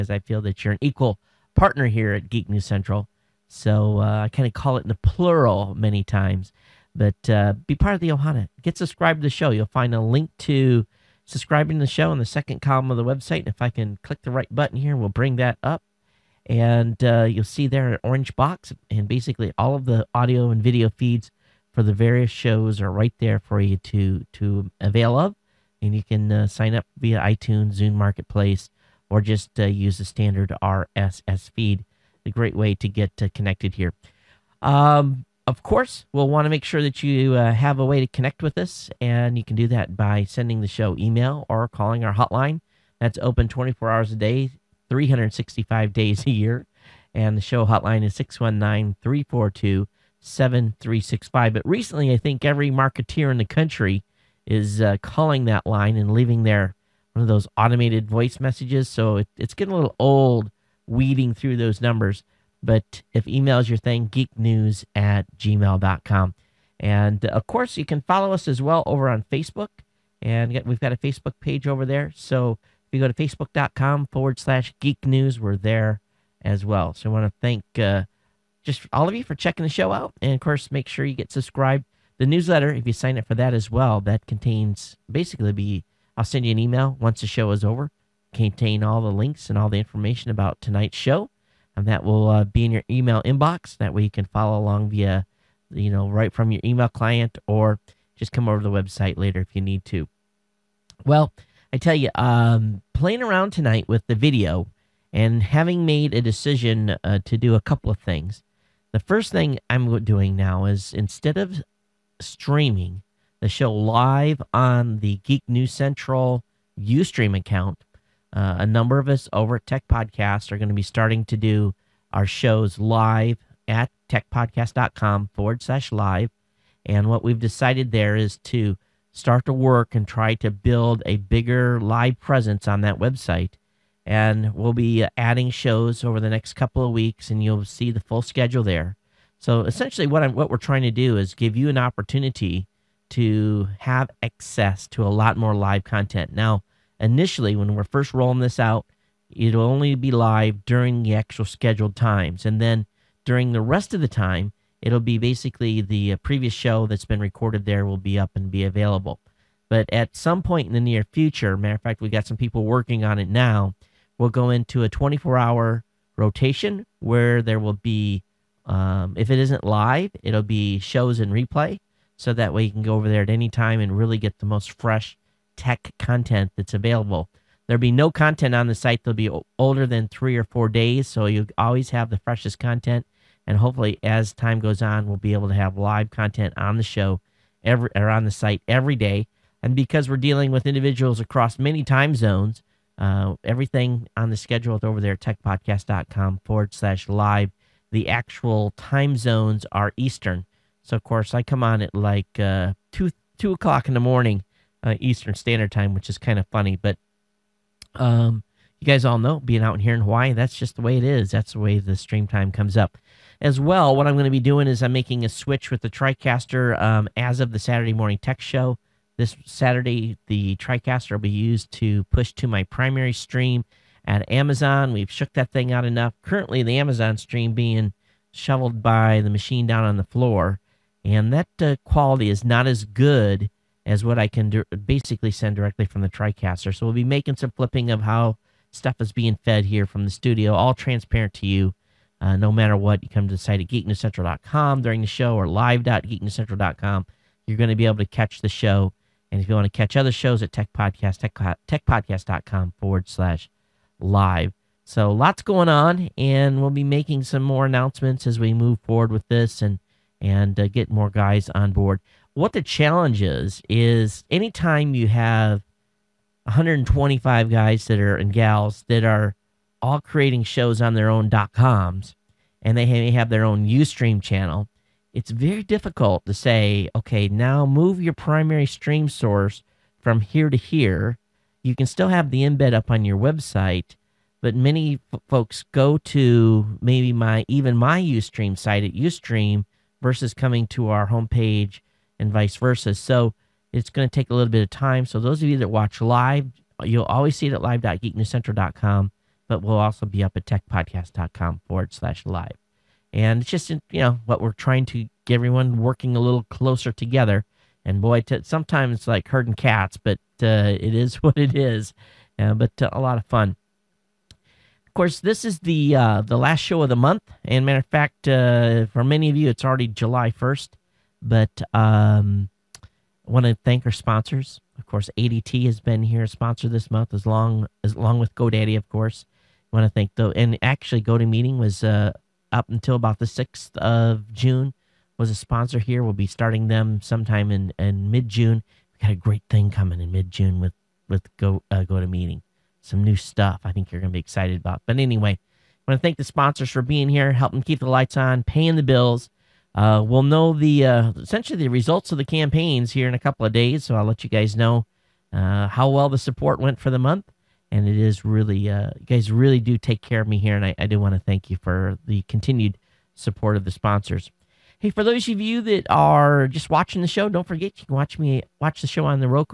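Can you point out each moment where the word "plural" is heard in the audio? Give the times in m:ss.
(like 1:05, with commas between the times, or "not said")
0:05.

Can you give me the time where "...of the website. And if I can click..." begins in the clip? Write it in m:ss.
0:12.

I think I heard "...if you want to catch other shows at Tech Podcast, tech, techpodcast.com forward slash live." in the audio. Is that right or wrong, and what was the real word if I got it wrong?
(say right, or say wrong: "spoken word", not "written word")
right.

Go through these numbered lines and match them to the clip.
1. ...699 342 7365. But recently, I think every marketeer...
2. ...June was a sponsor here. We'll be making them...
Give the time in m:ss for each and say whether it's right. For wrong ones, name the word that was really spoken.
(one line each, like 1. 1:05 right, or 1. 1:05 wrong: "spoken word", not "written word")
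1. 0:48 wrong: "619", not "699"
2. 5:34 wrong: "starting", not "making".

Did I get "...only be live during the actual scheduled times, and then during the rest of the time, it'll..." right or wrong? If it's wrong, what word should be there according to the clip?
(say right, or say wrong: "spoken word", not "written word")
right.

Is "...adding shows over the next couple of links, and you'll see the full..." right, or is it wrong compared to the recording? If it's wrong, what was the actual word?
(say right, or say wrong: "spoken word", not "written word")
wrong: "weeks", not "links".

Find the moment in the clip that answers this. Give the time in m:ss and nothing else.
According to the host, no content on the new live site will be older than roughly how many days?
3:00.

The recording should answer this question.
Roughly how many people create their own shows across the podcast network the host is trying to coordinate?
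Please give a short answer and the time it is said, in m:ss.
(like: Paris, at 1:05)
125, at 4:26.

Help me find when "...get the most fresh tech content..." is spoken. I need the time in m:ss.
2:54.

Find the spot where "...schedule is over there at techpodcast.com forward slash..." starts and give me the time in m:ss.
3:14.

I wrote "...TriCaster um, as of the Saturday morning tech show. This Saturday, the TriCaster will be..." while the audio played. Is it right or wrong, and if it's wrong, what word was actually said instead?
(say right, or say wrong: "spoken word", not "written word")
right.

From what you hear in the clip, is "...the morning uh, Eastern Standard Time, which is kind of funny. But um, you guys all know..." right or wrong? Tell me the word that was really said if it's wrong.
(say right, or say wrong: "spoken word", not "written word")
right.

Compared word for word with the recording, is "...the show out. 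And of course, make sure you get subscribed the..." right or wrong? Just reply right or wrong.
right.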